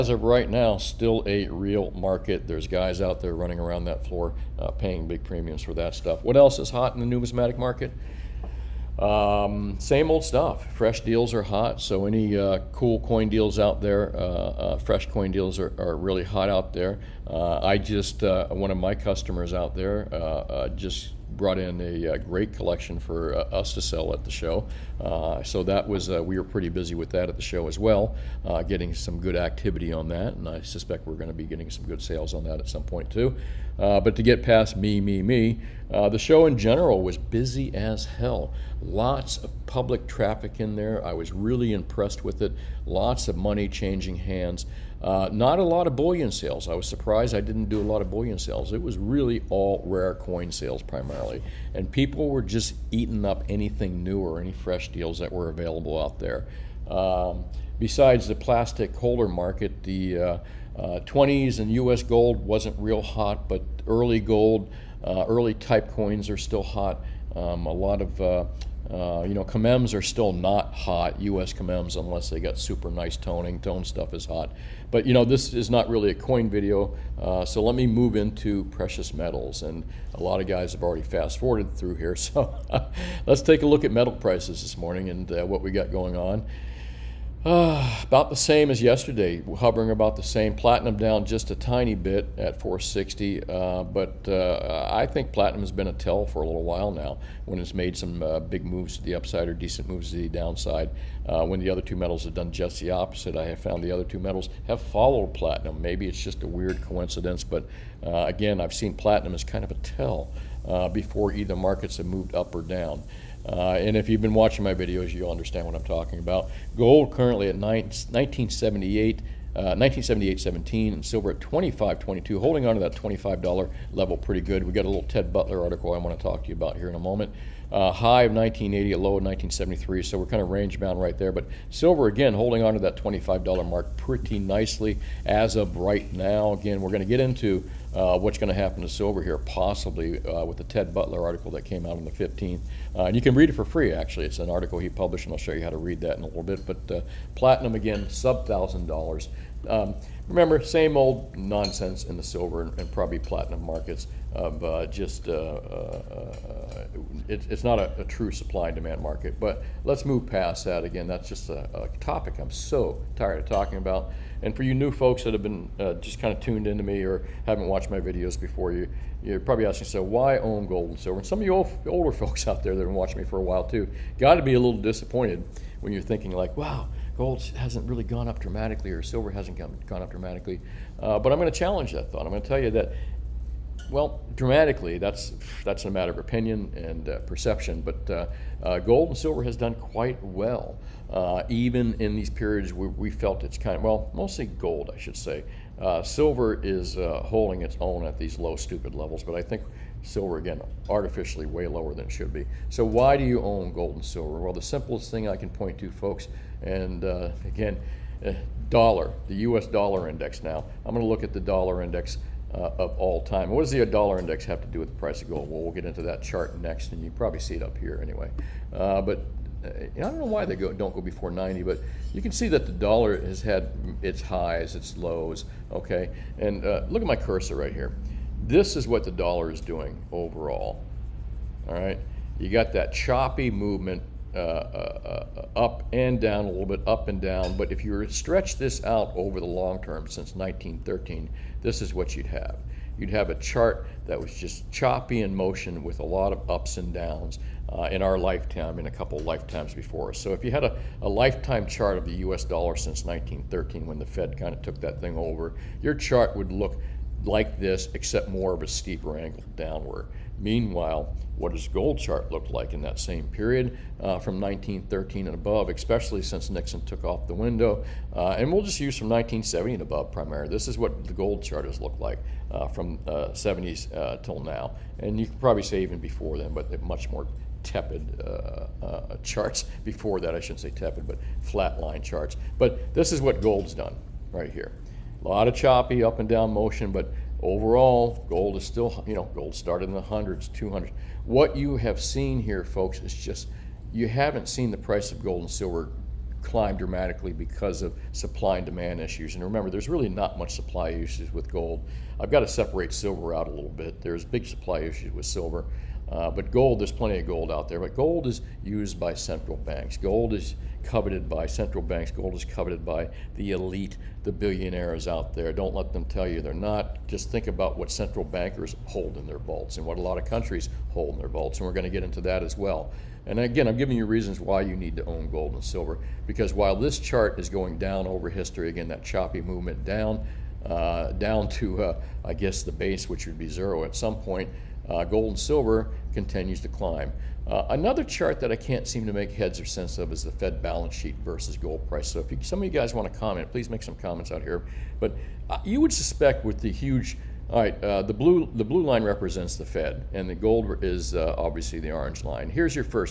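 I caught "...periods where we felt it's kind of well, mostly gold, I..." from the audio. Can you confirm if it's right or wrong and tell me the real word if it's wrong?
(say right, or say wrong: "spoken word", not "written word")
right.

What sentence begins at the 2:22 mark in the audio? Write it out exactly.
Uh, and you can read it for free, actually.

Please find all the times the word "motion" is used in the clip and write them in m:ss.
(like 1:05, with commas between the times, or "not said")
4:05, 4:46.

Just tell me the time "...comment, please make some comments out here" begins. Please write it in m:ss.
5:43.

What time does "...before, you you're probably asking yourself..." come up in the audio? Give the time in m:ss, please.
2:48.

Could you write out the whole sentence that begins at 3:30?
Now I'm going to look at the dollar index uh, of all time.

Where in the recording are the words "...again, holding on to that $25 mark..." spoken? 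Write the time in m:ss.
2:12.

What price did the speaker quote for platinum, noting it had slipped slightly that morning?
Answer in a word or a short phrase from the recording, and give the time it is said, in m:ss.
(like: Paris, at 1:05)
460, at 1:32.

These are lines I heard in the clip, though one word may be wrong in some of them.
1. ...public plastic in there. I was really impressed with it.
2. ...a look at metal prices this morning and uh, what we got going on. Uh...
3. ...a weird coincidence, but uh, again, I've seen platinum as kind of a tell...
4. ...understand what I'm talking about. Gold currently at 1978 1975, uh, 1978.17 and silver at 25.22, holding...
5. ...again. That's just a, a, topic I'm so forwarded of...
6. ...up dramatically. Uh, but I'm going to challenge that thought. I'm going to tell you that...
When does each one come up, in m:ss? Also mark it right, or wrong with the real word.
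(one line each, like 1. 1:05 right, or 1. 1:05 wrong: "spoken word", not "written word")
1. 0:39 wrong: "traffic", not "plastic"
2. 1:23 right
3. 1:46 right
4. 1:55 wrong: "1978", not "1975"
5. 2:40 wrong: "tired", not "forwarded"
6. 3:00 right.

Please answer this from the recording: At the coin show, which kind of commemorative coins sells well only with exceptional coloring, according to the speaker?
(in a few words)
U.S. commems.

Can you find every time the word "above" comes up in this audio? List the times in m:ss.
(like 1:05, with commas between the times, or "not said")
4:25, 4:29.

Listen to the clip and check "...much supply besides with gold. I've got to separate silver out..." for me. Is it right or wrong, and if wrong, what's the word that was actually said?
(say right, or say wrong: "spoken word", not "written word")
wrong: "issues", not "besides".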